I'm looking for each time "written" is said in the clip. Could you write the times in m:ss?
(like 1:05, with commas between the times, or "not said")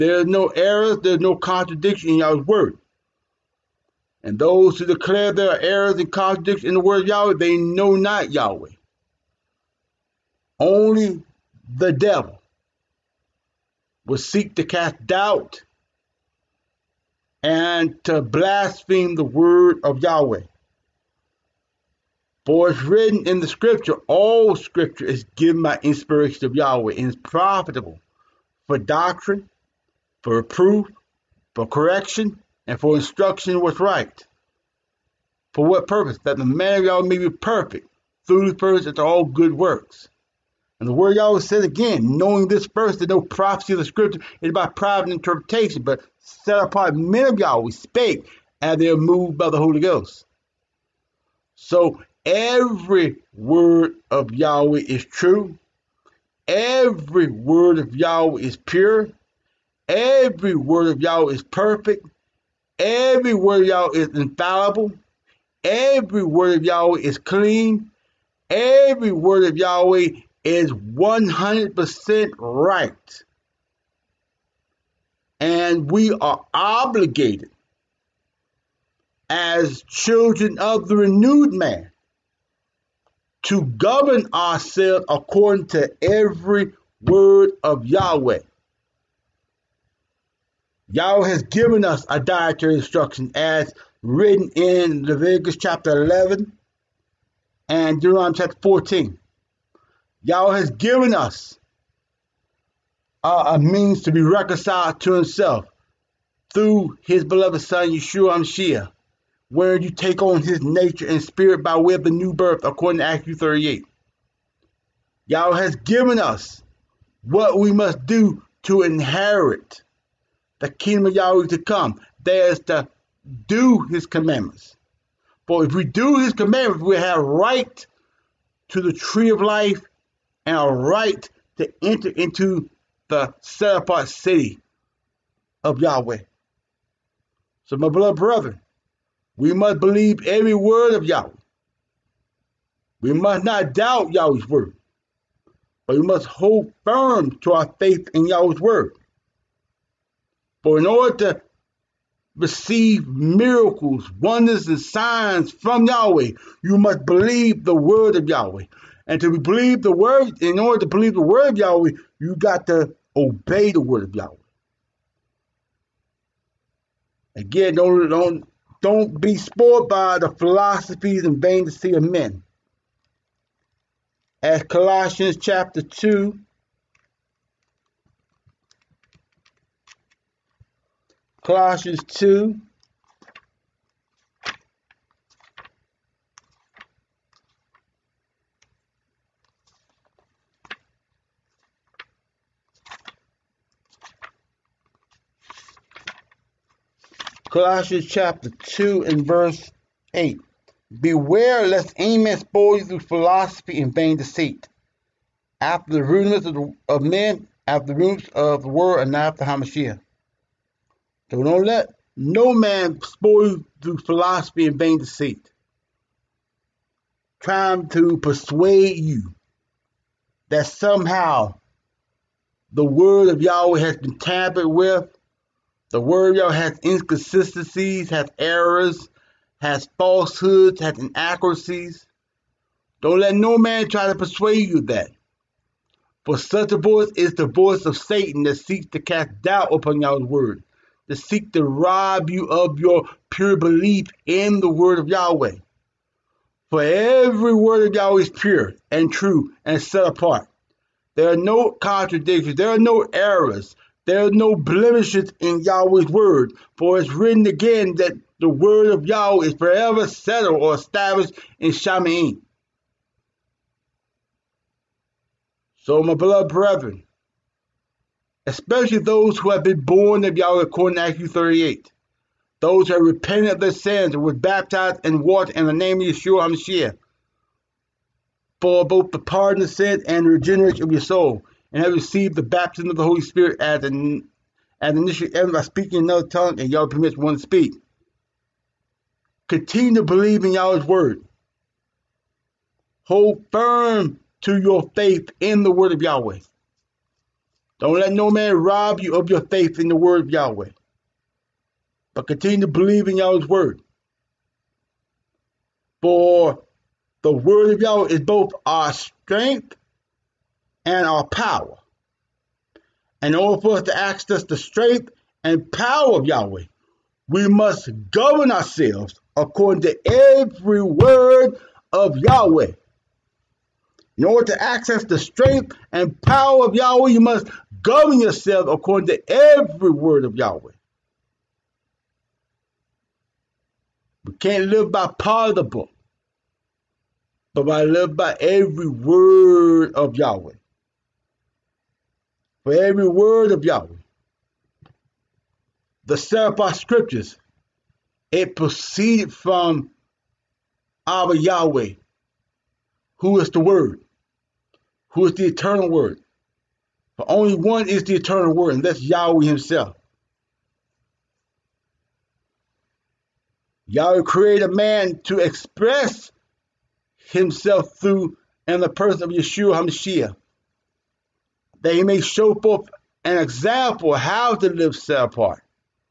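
0:22, 1:34, 4:17.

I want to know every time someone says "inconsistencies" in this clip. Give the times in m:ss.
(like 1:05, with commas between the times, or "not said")
3:46.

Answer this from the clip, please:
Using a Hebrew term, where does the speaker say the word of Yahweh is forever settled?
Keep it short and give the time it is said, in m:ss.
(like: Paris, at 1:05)
Shamaim, at 4:21.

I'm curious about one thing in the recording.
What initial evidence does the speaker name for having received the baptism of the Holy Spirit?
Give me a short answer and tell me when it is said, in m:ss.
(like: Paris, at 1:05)
speaking another tongue, at 4:45.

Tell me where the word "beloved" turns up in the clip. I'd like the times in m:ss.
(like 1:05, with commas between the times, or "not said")
1:47, 2:17, 4:26.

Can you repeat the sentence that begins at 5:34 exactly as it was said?
We can't live by part of the book, but by live by every word of Yahweh for every word of Yahweh.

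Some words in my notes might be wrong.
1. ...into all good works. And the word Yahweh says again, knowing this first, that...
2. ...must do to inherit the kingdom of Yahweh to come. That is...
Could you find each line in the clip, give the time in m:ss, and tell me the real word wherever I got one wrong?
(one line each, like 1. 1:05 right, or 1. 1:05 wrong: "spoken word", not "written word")
1. 0:38 right
2. 1:57 right.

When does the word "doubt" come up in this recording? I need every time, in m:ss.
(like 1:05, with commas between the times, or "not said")
0:15, 2:23, 3:59.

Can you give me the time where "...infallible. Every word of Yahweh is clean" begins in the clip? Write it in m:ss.
1:04.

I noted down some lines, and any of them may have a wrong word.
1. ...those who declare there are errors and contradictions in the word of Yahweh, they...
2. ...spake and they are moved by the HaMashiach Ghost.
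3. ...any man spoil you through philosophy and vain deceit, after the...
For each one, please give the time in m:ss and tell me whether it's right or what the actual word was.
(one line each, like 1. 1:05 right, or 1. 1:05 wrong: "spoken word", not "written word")
1. 0:04 right
2. 0:47 wrong: "Holy", not "HaMashiach"
3. 3:21 right.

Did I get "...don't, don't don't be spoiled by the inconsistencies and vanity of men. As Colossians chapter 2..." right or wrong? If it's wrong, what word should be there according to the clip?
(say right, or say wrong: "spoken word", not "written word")
wrong: "philosophies", not "inconsistencies".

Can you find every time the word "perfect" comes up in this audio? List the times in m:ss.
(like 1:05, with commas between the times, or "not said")
0:37, 1:01.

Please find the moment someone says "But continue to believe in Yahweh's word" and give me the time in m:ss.
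5:02.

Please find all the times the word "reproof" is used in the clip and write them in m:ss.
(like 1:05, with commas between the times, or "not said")
0:30.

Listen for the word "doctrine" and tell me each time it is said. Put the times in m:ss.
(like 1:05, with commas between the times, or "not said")
0:28.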